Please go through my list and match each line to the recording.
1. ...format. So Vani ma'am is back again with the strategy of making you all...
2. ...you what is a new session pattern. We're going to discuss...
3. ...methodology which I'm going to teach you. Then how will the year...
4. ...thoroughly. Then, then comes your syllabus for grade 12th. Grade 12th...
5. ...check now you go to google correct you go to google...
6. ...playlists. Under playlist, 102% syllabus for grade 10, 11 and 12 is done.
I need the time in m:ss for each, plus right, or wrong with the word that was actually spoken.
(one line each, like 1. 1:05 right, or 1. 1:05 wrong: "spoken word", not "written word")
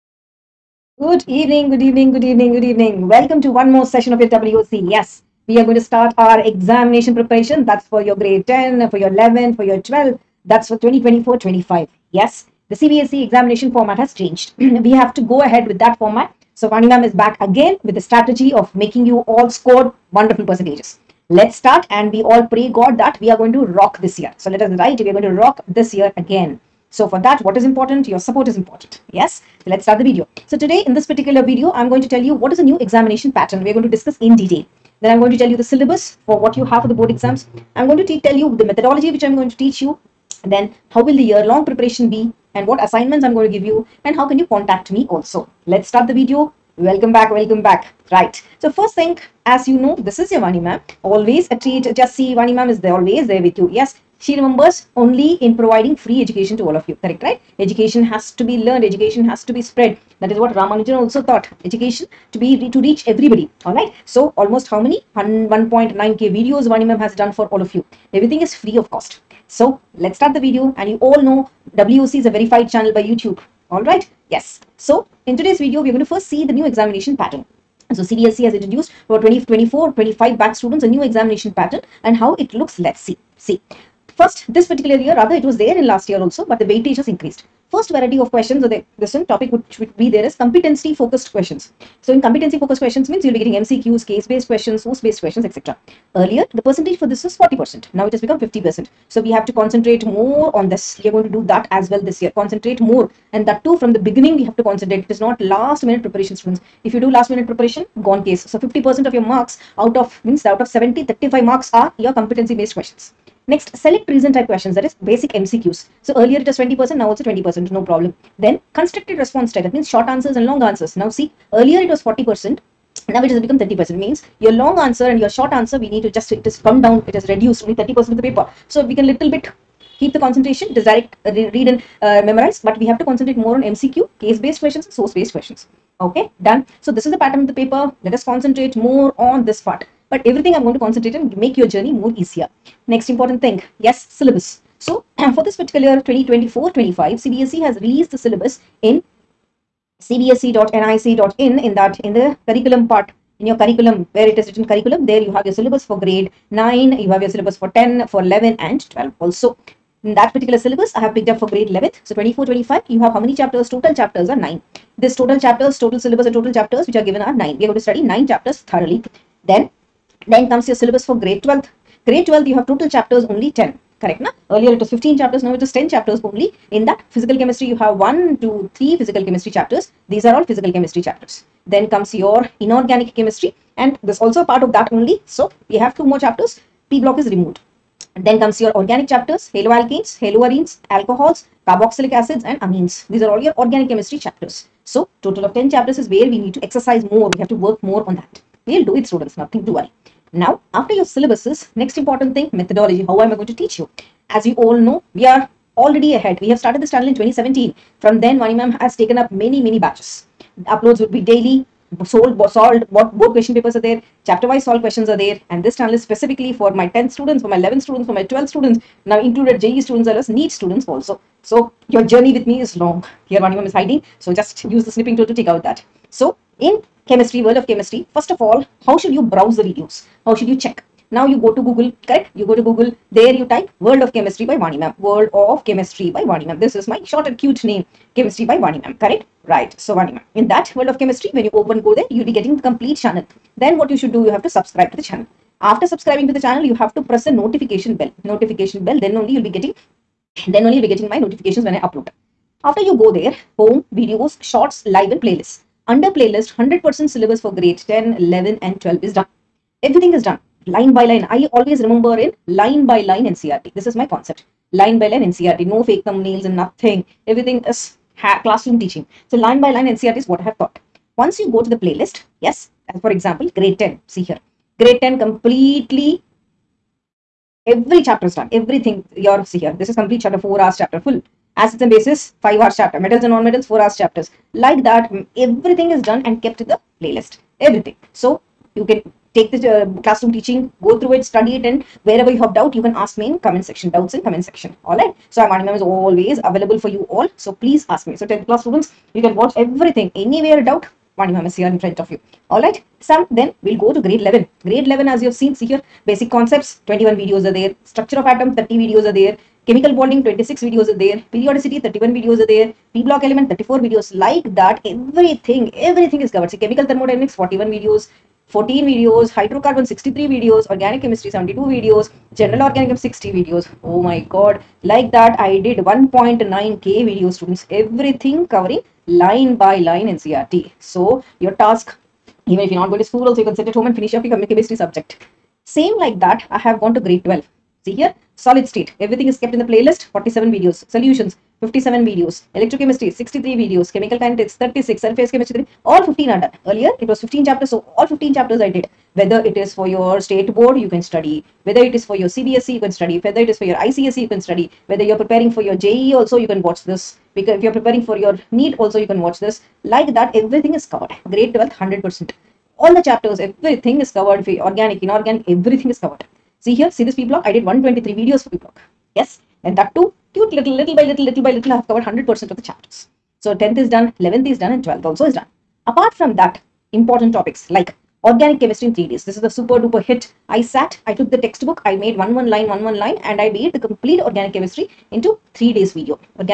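1. 0:15 right
2. 0:32 wrong: "examination", not "session"
3. 0:38 right
4. 2:48 right
5. 3:50 right
6. 4:15 wrong: "100", not "102".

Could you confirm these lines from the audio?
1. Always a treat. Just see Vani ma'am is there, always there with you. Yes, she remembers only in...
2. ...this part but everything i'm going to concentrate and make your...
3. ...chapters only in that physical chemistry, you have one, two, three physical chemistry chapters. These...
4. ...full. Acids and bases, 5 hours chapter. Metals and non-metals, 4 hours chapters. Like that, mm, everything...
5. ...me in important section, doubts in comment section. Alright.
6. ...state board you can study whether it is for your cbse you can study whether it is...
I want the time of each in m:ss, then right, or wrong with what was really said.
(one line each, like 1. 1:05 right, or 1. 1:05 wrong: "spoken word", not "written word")
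1. 0:51 right
2. 2:19 right
3. 2:55 right
4. 4:40 right
5. 4:53 wrong: "comment", not "important"
6. 5:50 right.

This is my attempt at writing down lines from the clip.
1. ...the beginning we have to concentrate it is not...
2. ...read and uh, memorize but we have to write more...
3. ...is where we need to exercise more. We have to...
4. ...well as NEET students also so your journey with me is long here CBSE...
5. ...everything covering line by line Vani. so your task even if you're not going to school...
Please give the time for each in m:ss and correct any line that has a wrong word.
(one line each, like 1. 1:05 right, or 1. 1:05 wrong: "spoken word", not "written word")
1. 1:43 right
2. 2:11 wrong: "concentrate", not "write"
3. 3:16 right
4. 3:40 wrong: "Vani", not "CBSE"
5. 5:27 wrong: "NCERT", not "Vani".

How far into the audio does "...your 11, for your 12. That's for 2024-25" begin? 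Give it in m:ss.
0:08.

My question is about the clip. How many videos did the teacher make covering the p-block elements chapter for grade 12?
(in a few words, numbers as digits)
123.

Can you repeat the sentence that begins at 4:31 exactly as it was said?
Once you go to the playlist, Yes, and for example, grade 10, see here.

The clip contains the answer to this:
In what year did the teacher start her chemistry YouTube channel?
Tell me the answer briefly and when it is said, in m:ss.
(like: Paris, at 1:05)
2017, at 3:27.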